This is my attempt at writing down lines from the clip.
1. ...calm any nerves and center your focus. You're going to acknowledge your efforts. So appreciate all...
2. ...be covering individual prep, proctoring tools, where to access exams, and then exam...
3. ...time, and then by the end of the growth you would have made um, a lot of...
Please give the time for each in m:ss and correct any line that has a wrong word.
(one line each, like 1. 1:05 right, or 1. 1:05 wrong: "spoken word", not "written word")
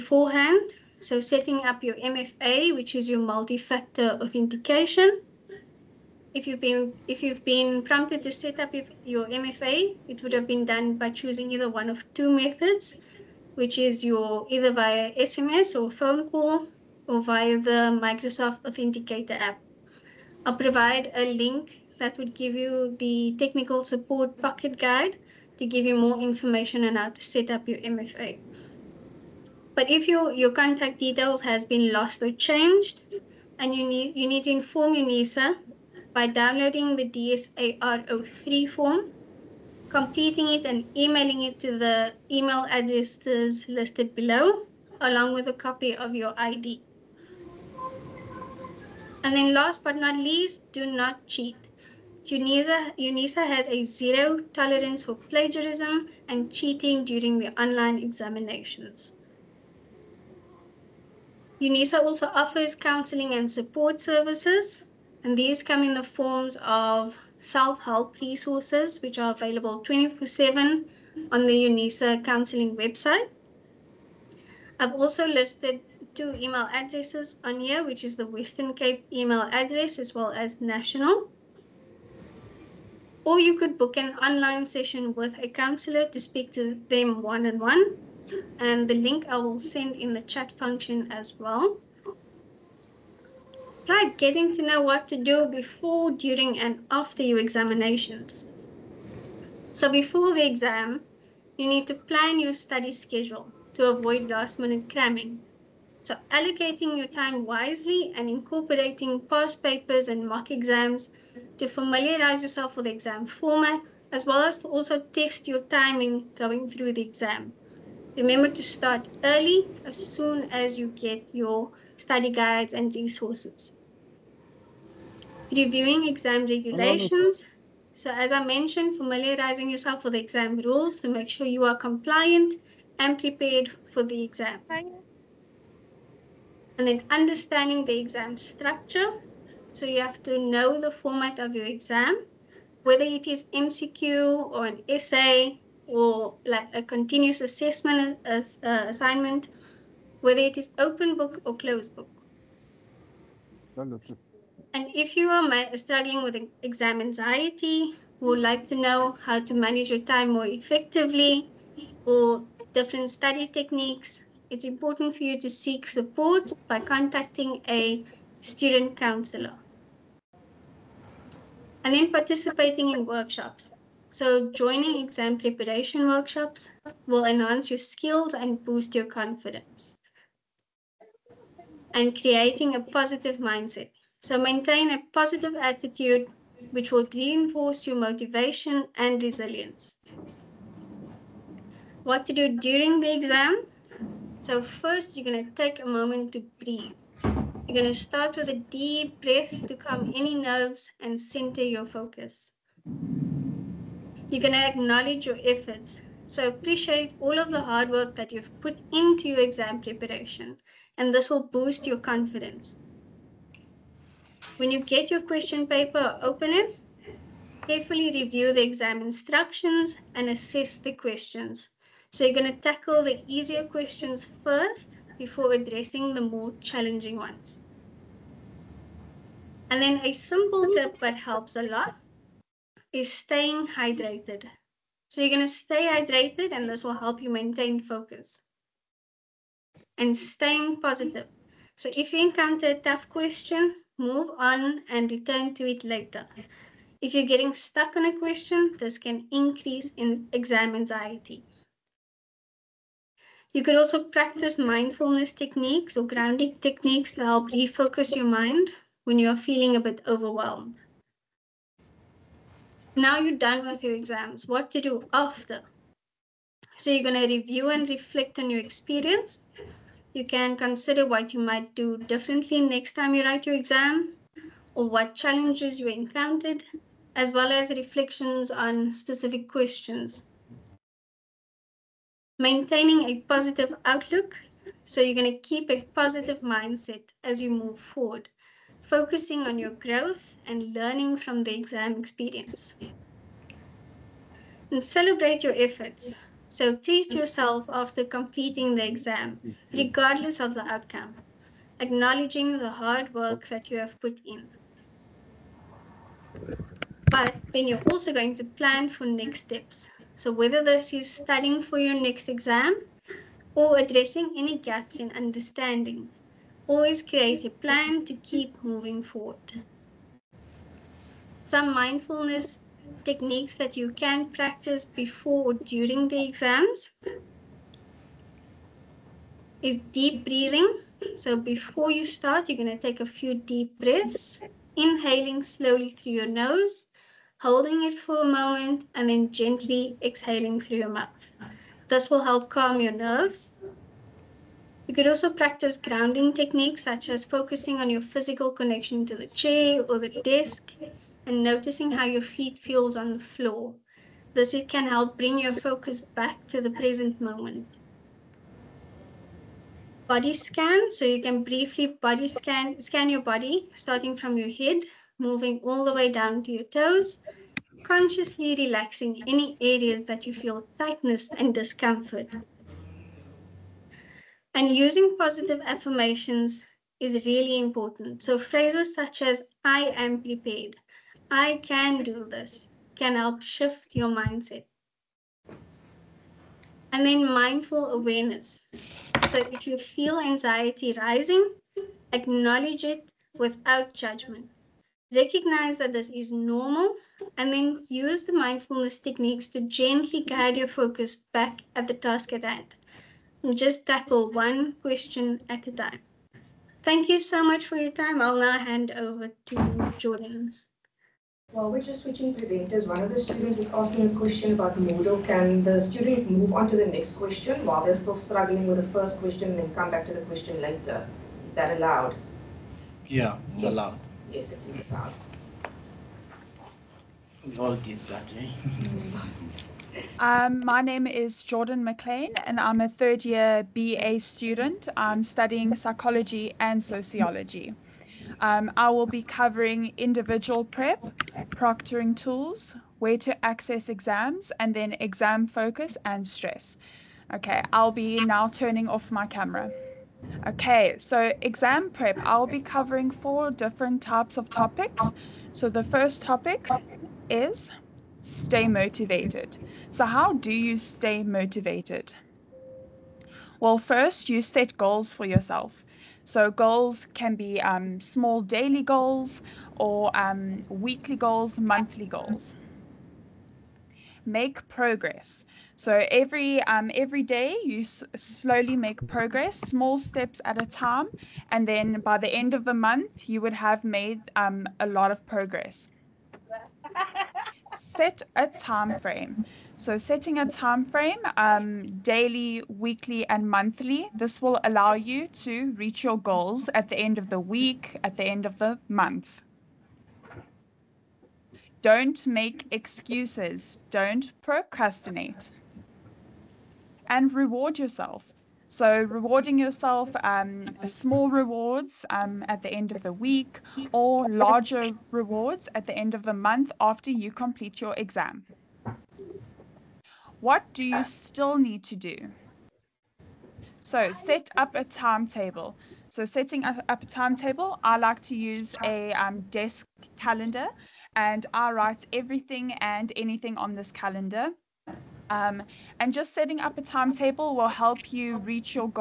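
1. 3:19 right
2. 7:19 right
3. 8:00 wrong: "month", not "growth".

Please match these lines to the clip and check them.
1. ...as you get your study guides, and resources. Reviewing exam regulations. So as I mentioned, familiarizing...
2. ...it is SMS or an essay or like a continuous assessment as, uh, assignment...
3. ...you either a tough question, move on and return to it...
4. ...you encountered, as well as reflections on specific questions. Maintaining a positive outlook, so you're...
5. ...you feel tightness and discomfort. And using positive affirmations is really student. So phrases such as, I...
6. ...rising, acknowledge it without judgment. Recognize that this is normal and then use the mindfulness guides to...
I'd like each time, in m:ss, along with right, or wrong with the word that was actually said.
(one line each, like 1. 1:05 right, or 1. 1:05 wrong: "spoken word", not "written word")
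1. 2:00 right
2. 2:23 wrong: "MCQ", not "SMS"
3. 4:02 wrong: "encounter", not "either"
4. 4:35 right
5. 6:10 wrong: "important", not "student"
6. 6:30 wrong: "techniques", not "guides".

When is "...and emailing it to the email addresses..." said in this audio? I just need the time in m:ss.
0:40.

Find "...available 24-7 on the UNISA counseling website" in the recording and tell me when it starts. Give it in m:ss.
1:09.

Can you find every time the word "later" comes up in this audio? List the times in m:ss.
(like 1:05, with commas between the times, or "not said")
4:05, 7:00.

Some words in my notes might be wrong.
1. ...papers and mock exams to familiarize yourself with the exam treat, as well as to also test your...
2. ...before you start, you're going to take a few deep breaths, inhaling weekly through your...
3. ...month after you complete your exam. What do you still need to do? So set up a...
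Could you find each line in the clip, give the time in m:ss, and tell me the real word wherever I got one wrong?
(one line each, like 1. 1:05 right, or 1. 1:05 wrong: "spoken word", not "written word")
1. 1:49 wrong: "format", not "treat"
2. 5:31 wrong: "slowly", not "weekly"
3. 8:36 right.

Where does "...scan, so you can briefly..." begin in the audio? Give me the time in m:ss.
6:00.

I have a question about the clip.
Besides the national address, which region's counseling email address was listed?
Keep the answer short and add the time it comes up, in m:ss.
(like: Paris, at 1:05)
Western Cape, at 1:18.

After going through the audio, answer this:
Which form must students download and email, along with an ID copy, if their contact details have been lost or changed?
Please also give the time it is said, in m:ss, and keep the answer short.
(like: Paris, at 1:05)
DSARO 3, at 0:37.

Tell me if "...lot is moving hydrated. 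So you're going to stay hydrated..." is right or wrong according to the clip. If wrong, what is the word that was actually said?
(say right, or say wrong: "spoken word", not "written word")
wrong: "staying", not "moving".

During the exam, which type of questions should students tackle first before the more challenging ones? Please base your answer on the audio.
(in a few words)
The easier questions.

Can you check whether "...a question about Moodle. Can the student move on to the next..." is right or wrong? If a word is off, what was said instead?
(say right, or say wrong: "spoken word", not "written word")
right.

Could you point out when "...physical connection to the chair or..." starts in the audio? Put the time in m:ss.
5:48.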